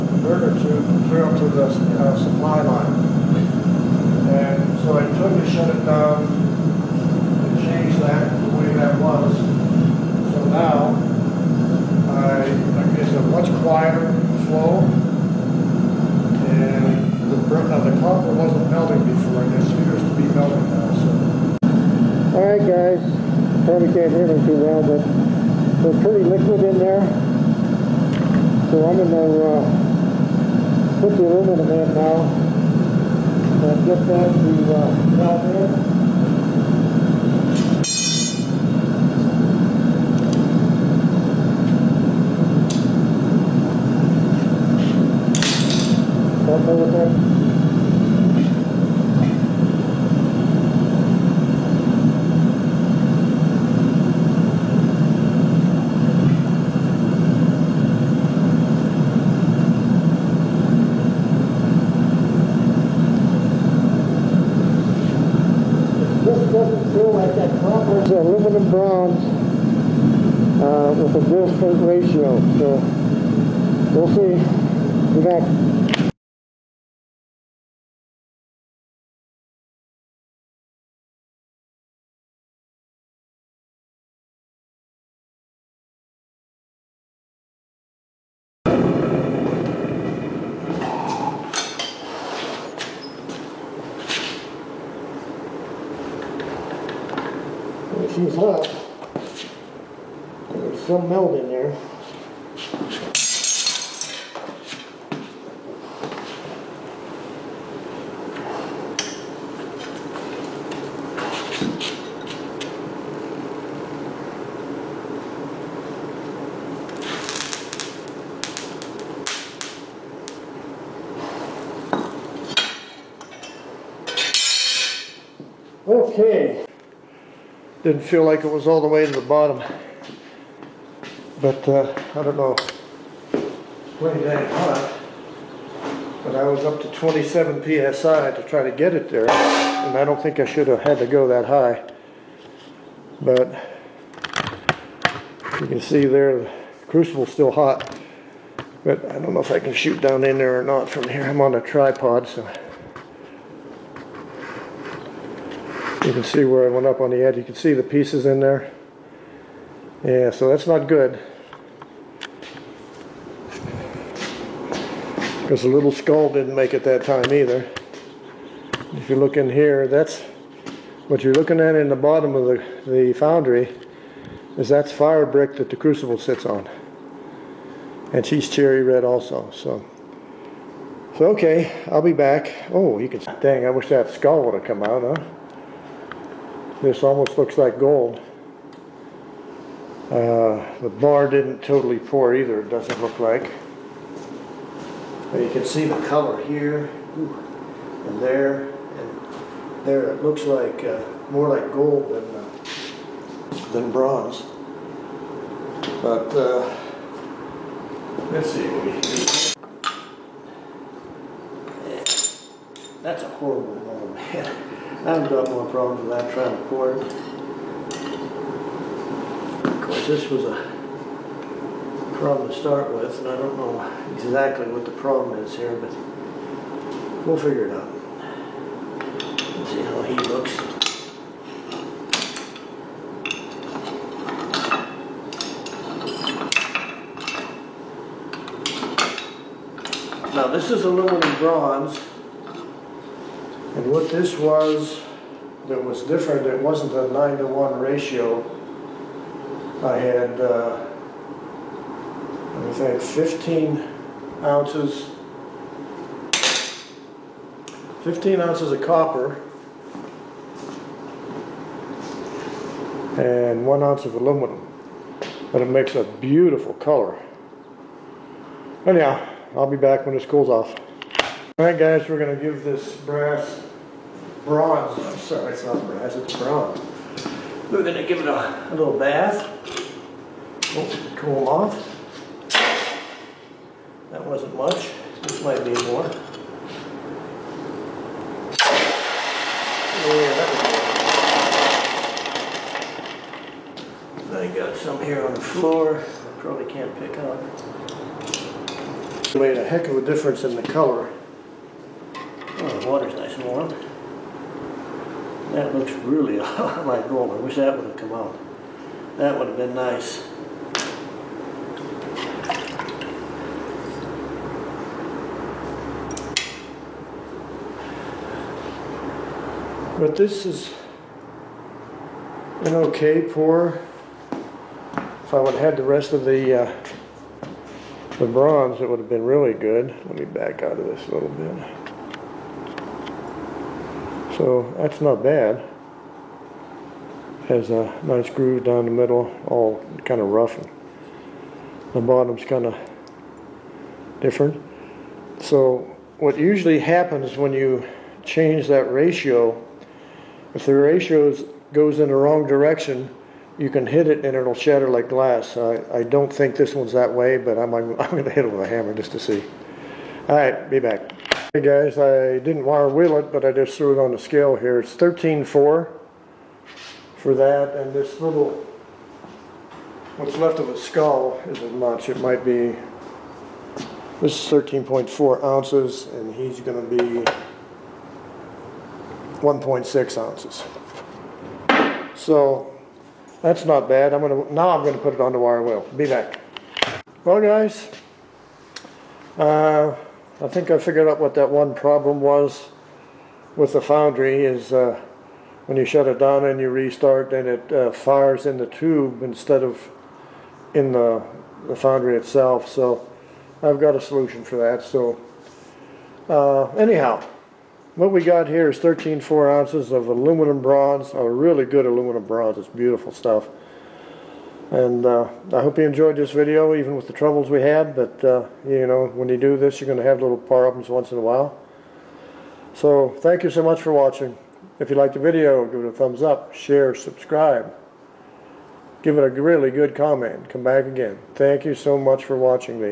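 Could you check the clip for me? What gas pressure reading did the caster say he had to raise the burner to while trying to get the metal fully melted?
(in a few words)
27 psi.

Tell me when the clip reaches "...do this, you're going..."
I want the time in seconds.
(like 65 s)
419 s.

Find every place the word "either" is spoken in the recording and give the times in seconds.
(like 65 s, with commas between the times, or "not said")
167 s, 192 s.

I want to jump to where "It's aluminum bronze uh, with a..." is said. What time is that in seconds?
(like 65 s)
68 s.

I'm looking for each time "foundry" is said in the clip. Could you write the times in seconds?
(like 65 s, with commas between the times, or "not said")
173 s, 393 s, 401 s.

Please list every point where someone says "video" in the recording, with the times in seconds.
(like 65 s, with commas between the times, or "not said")
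416 s, 425 s.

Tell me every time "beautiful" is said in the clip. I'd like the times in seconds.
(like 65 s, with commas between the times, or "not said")
266 s, 412 s.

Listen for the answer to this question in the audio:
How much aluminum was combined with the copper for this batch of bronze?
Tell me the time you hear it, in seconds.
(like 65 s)
263 s.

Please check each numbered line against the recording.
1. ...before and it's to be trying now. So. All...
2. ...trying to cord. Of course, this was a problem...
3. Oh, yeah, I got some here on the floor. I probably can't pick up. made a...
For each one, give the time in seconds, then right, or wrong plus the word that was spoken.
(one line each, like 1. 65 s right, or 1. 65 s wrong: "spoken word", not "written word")
1. 19 s wrong: "melting", not "trying"
2. 216 s right
3. 290 s right.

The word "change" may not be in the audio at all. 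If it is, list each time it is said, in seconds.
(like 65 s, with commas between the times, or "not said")
7 s, 348 s.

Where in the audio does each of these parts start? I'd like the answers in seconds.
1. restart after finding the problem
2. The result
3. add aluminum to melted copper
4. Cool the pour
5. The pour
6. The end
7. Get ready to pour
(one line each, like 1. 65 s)
1. 7 s
2. 194 s
3. 42 s
4. 274 s
5. 126 s
6. 417 s
7. 88 s.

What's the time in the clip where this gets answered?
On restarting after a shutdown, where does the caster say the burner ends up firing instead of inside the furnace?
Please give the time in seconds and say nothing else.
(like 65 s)
398 s.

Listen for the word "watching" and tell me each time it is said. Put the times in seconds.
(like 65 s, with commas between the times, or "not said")
423 s, 432 s.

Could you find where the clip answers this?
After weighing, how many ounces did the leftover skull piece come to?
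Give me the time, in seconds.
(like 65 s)
379 s.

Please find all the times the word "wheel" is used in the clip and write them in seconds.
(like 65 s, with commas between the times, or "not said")
362 s, 385 s.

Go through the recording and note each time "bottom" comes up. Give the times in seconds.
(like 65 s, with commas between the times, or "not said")
129 s, 171 s, 342 s.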